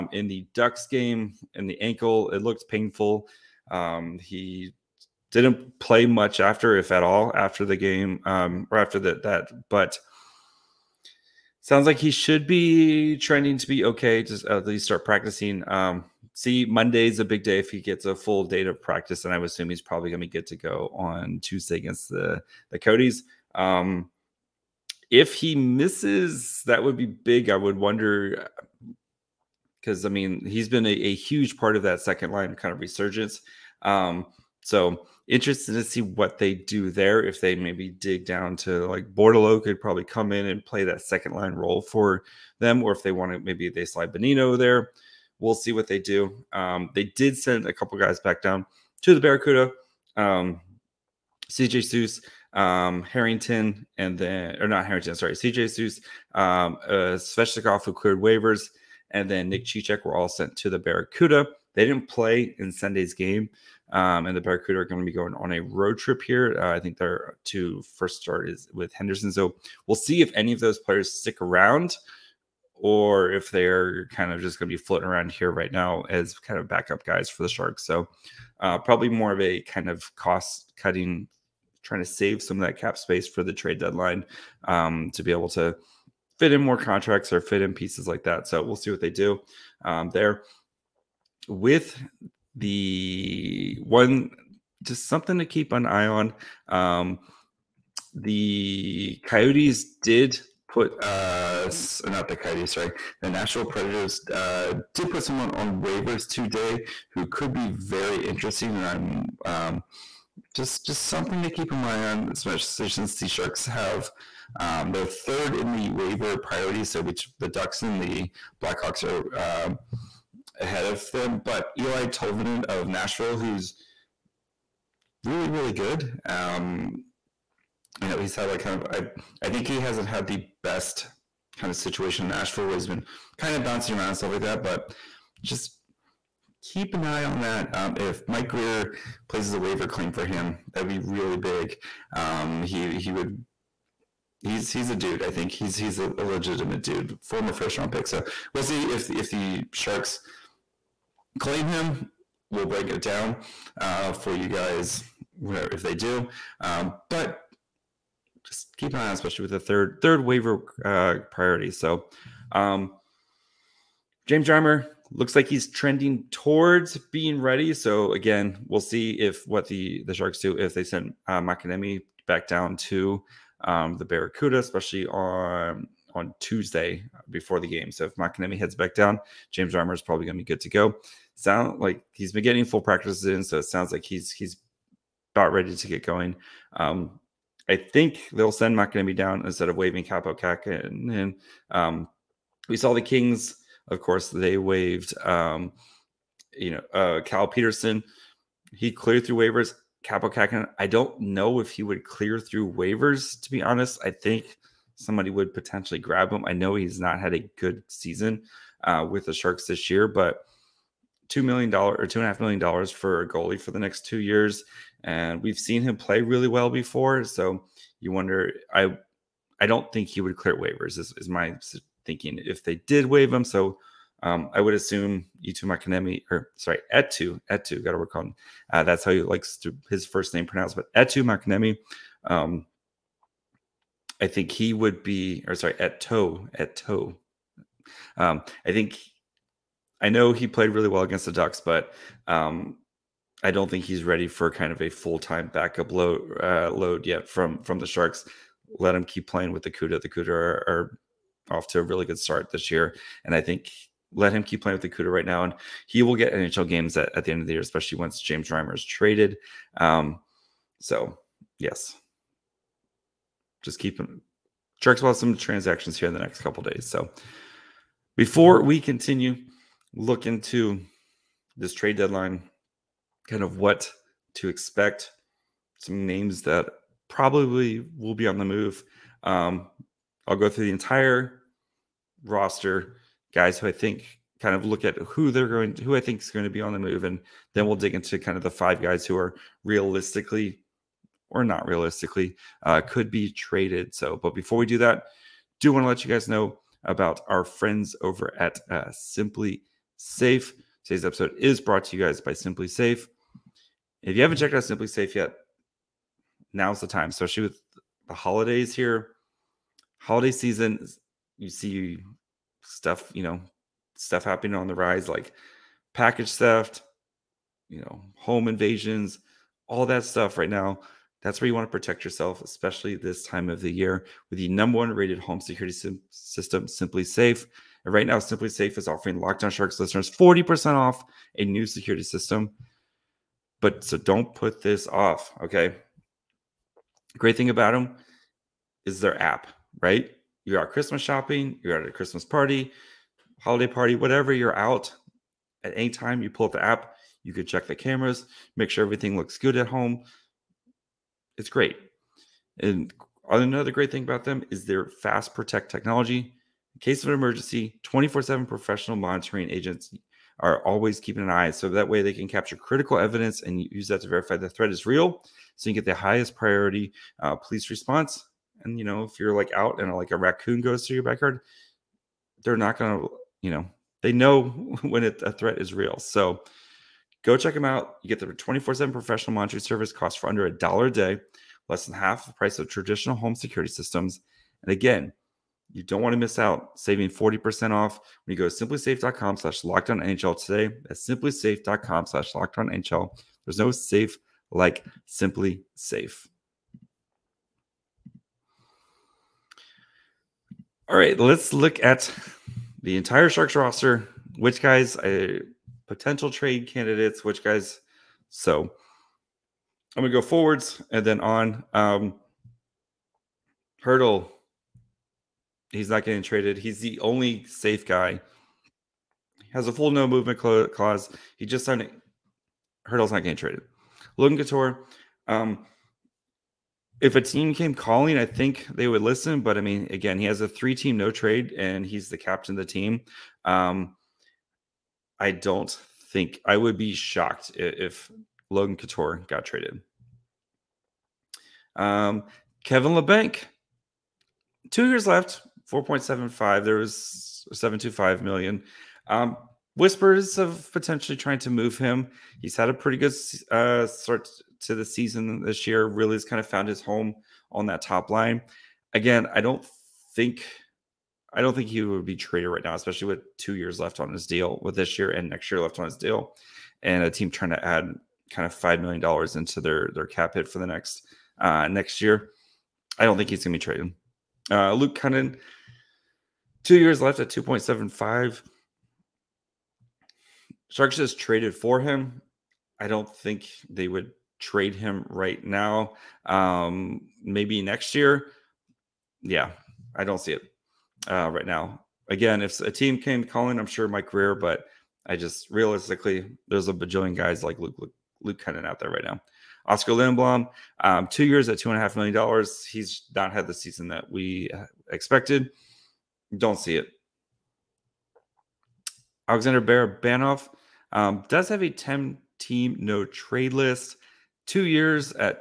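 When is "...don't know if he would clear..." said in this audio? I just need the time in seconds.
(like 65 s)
200 s.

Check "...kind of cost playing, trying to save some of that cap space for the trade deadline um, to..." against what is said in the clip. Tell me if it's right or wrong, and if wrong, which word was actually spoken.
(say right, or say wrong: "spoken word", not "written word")
wrong: "cutting", not "playing".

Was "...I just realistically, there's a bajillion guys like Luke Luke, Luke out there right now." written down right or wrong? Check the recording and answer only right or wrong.
right.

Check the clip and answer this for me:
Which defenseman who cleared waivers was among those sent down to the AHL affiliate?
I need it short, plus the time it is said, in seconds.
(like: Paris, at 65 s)
Sveshnikov, at 57 s.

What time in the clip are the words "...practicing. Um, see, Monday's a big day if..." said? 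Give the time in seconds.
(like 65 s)
15 s.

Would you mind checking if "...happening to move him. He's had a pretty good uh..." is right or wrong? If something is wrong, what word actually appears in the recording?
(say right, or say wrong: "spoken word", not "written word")
wrong: "trying", not "happening".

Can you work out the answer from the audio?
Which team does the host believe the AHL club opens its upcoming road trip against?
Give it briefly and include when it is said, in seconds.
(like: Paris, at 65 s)
Henderson, at 68 s.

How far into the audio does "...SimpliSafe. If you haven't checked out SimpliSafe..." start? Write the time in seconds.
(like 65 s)
302 s.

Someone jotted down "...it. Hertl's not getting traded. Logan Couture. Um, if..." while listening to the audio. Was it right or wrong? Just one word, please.
right.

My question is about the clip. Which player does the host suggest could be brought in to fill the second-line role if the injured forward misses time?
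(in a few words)
Bordeleau.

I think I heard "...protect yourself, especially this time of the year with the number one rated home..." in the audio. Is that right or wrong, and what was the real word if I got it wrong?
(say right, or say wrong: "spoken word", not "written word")
right.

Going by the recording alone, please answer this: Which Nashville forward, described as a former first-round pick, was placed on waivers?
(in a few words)
Eeli Tolvanen.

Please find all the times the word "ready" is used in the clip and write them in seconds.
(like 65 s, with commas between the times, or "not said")
167 s, 185 s, 244 s.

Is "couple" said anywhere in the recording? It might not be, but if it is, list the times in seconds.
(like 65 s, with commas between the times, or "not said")
47 s, 266 s.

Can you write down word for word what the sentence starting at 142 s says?
Um, he he would he's he's a dude.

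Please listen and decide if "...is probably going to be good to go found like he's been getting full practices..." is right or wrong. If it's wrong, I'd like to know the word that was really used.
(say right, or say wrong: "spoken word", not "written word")
wrong: "sound", not "found".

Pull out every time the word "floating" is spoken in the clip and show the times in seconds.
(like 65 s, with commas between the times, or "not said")
74 s.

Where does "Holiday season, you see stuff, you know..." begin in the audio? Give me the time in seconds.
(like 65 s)
309 s.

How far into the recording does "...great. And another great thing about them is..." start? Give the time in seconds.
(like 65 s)
351 s.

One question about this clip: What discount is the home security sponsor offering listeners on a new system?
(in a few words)
40%.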